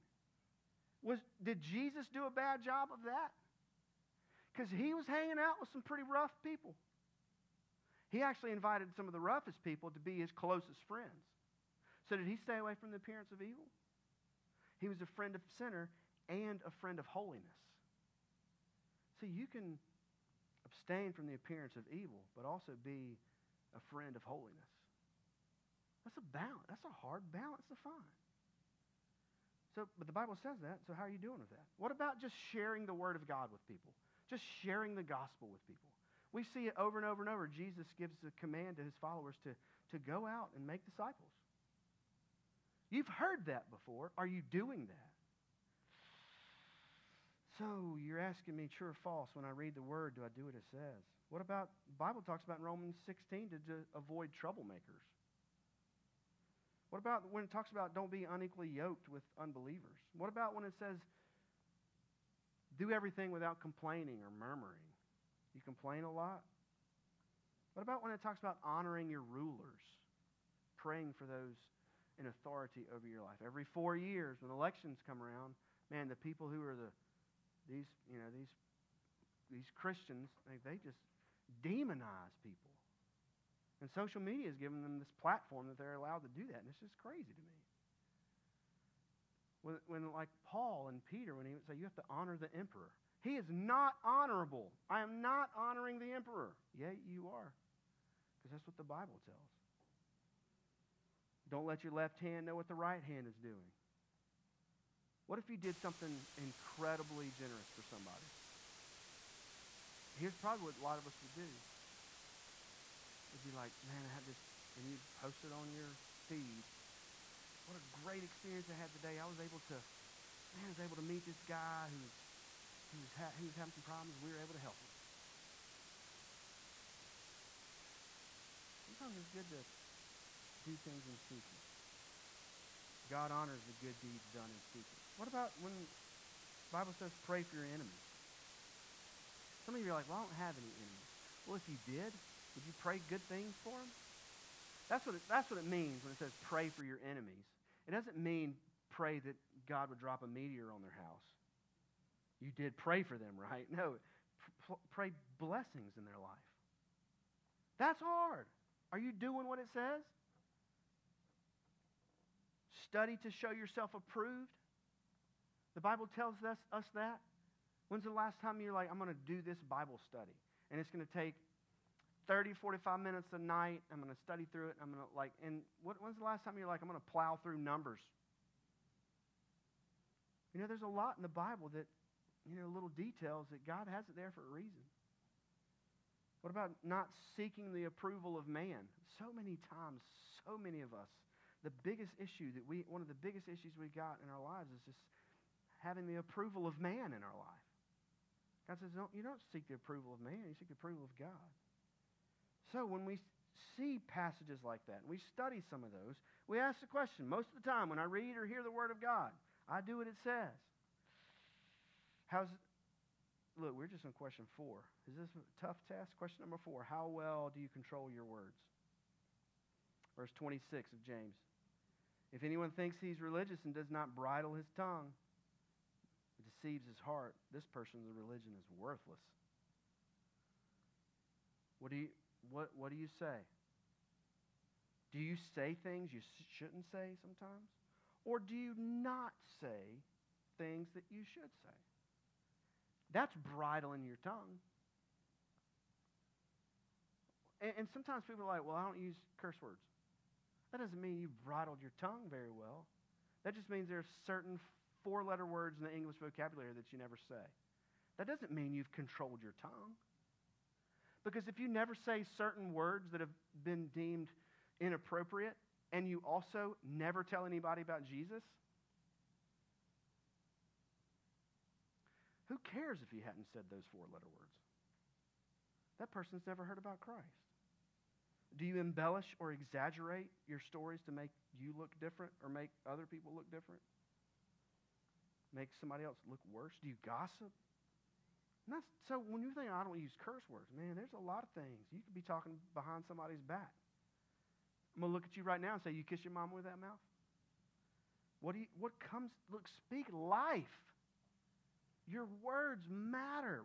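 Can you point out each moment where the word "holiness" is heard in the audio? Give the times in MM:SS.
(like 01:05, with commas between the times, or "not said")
00:17, 00:24.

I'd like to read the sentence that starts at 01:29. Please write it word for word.
When, when like Paul and Peter, when he would say, "You have to honor the emperor," he is not honorable.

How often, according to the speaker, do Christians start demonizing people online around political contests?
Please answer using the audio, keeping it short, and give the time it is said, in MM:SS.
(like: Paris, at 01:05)
Every four years, at 01:13.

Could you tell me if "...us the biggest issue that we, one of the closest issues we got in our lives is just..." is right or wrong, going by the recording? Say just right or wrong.
wrong.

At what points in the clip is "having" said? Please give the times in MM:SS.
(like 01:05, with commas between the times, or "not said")
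02:03, 03:15.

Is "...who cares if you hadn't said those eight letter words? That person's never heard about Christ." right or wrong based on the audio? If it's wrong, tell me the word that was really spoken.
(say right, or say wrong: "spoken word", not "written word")
wrong: "four", not "eight".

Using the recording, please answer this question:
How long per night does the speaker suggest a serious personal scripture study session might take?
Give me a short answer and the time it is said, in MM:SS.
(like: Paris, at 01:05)
30, 45 minutes, at 02:52.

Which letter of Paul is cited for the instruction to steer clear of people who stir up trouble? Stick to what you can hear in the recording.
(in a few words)
Romans 16.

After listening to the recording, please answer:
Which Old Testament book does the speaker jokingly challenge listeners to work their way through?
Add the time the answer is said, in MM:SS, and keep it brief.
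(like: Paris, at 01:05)
Numbers, at 02:57.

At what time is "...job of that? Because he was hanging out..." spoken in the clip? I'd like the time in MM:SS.
00:02.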